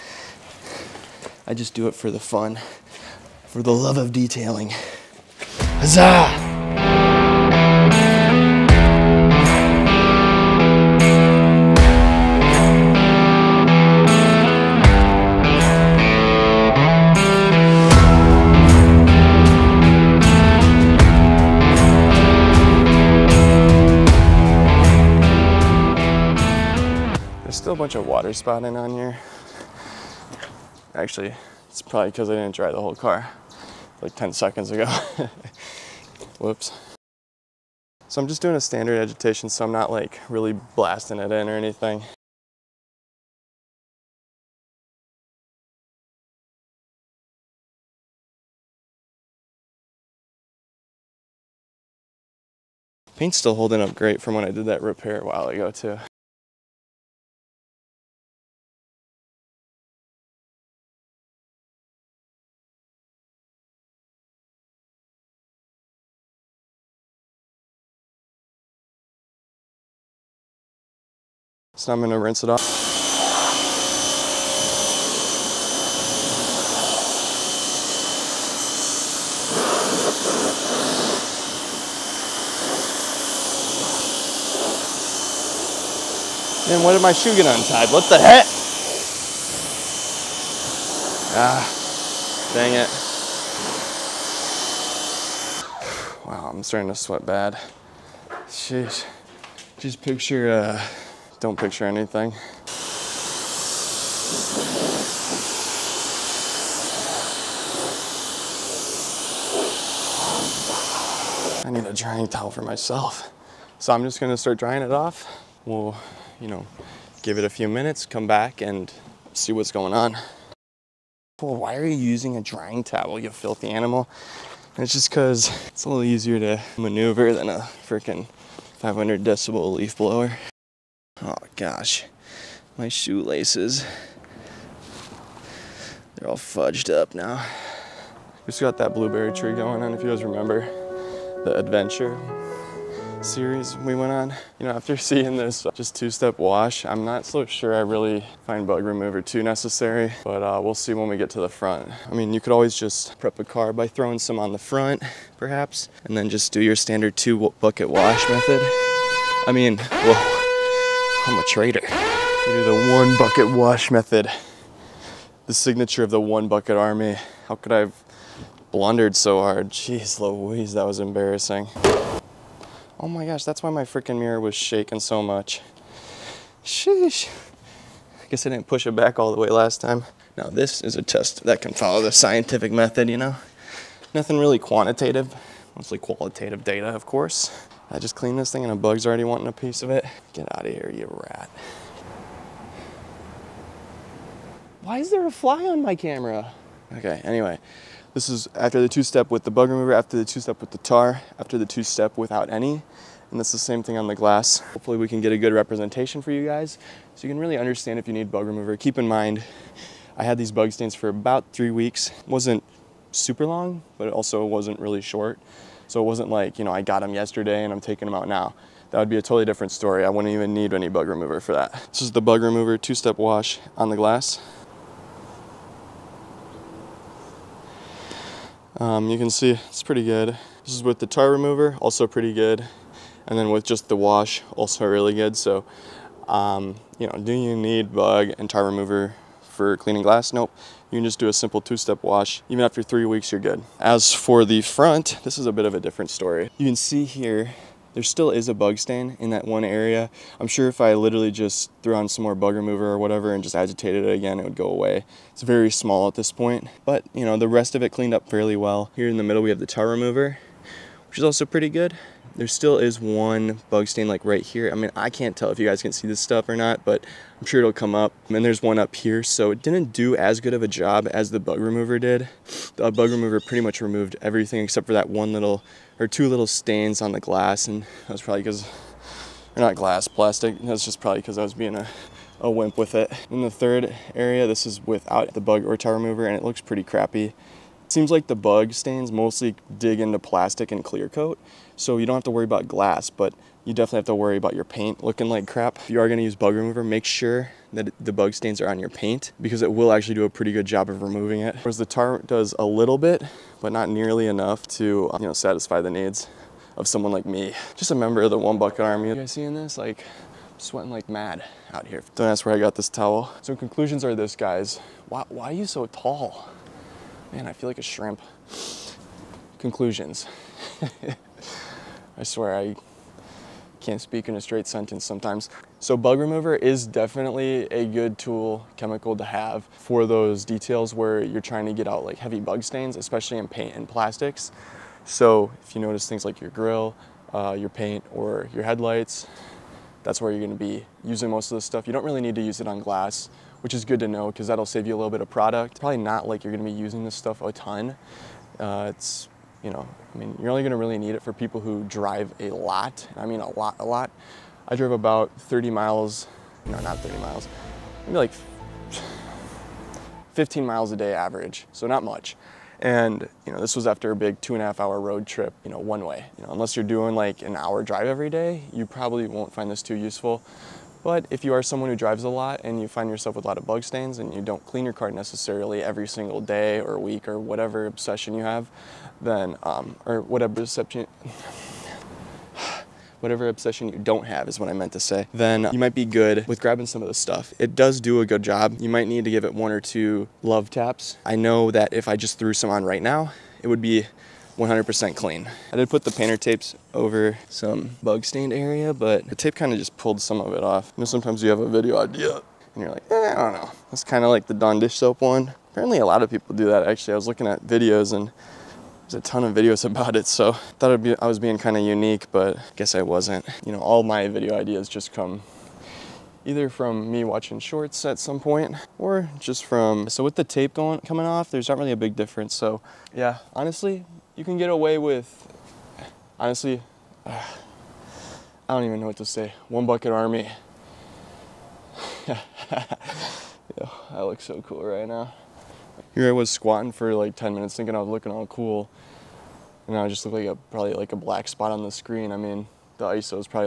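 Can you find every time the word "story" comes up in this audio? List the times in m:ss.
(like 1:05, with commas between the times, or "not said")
3:39, 4:06.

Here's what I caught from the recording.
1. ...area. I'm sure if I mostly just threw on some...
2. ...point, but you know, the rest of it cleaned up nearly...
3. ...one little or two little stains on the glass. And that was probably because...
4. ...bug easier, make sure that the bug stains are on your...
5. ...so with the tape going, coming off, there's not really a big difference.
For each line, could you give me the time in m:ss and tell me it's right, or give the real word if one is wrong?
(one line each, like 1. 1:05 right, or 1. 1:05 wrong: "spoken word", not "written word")
1. 4:09 wrong: "literally", not "mostly"
2. 4:16 wrong: "fairly", not "nearly"
3. 4:35 right
4. 4:56 wrong: "remover", not "easier"
5. 7:00 right.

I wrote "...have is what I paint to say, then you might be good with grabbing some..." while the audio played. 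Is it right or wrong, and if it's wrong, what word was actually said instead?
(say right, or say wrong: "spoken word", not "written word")
wrong: "meant", not "paint".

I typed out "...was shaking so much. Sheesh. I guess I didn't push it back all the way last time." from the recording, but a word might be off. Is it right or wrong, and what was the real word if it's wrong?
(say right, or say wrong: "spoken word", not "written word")
right.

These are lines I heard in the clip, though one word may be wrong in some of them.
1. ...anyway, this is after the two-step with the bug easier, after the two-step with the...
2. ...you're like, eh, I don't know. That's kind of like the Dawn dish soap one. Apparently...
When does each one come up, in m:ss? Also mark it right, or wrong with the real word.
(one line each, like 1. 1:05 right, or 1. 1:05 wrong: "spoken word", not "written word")
1. 3:17 wrong: "remover", not "easier"
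2. 6:42 right.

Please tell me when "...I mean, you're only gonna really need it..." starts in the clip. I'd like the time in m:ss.
5:50.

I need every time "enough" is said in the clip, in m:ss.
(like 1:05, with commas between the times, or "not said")
5:04.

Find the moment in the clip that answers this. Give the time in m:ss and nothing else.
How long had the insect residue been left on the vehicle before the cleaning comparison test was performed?
3:31.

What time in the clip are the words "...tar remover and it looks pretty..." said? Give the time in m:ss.
4:45.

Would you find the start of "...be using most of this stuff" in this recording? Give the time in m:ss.
5:40.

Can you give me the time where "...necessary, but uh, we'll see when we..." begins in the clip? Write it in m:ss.
2:29.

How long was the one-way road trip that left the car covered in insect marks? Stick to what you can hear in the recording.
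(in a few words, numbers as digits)
2.5 hours.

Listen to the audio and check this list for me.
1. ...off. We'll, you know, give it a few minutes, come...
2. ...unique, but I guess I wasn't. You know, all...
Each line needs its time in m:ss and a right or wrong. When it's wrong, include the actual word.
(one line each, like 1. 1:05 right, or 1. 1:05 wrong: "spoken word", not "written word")
1. 1:54 right
2. 6:51 right.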